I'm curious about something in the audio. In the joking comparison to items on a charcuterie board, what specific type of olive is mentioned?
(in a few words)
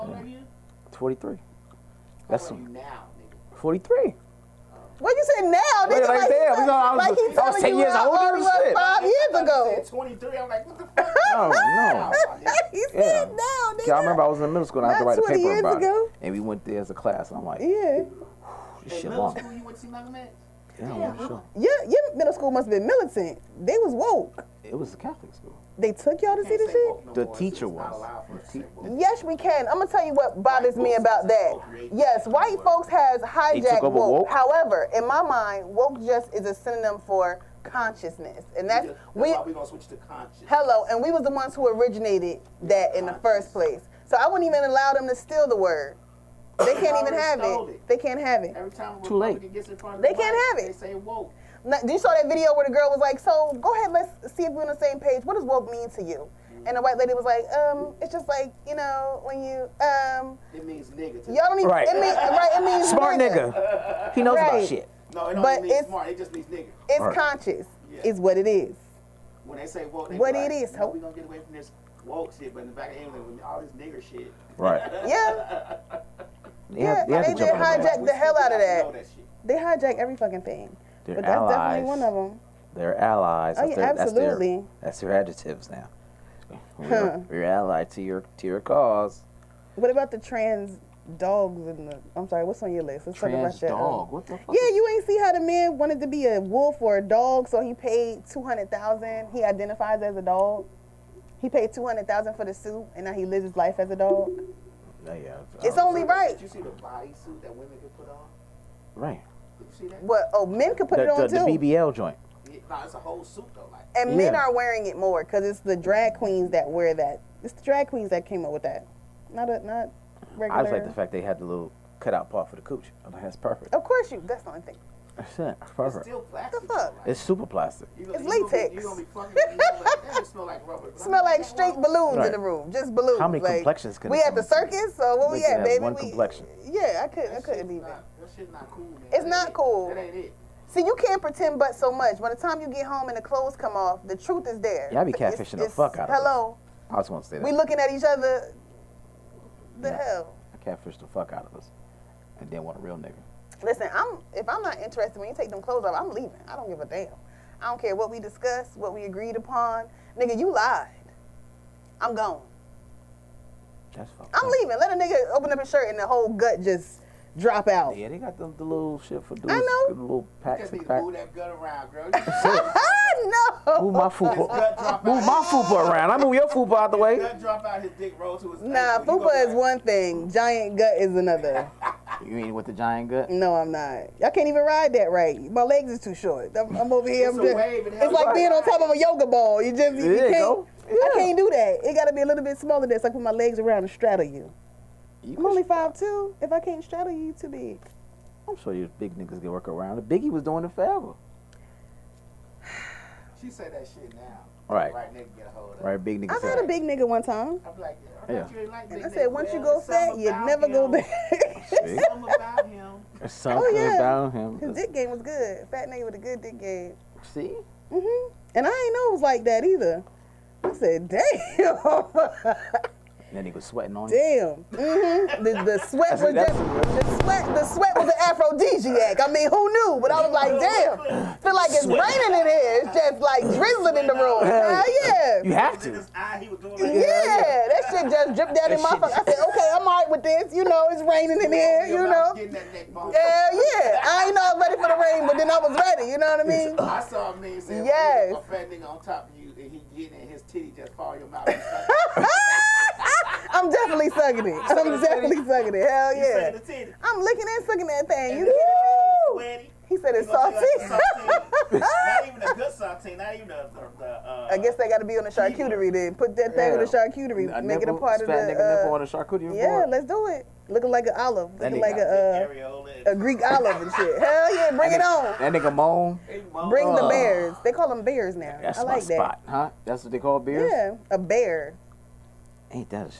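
Greek olive.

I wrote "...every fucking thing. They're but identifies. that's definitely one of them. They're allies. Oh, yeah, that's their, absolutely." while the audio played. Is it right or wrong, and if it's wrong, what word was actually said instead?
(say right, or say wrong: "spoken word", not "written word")
wrong: "allies", not "identifies".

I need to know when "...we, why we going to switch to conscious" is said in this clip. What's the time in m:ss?
0:39.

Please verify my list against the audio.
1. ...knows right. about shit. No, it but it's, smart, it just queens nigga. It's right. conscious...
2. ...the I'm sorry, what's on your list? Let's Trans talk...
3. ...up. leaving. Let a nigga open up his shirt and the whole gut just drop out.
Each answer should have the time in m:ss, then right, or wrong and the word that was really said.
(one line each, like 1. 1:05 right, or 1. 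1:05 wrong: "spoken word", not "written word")
1. 1:04 wrong: "means", not "queens"
2. 1:31 right
3. 2:44 right.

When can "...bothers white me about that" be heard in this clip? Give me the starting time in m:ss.
0:30.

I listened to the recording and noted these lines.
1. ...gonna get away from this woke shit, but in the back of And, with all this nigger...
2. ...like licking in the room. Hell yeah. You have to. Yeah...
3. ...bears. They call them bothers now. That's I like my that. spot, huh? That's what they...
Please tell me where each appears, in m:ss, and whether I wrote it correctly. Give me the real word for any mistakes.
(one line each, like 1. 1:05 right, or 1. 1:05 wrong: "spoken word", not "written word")
1. 1:10 wrong: "England", not "And"
2. 3:53 wrong: "drizzling", not "licking"
3. 4:37 wrong: "bears", not "bothers".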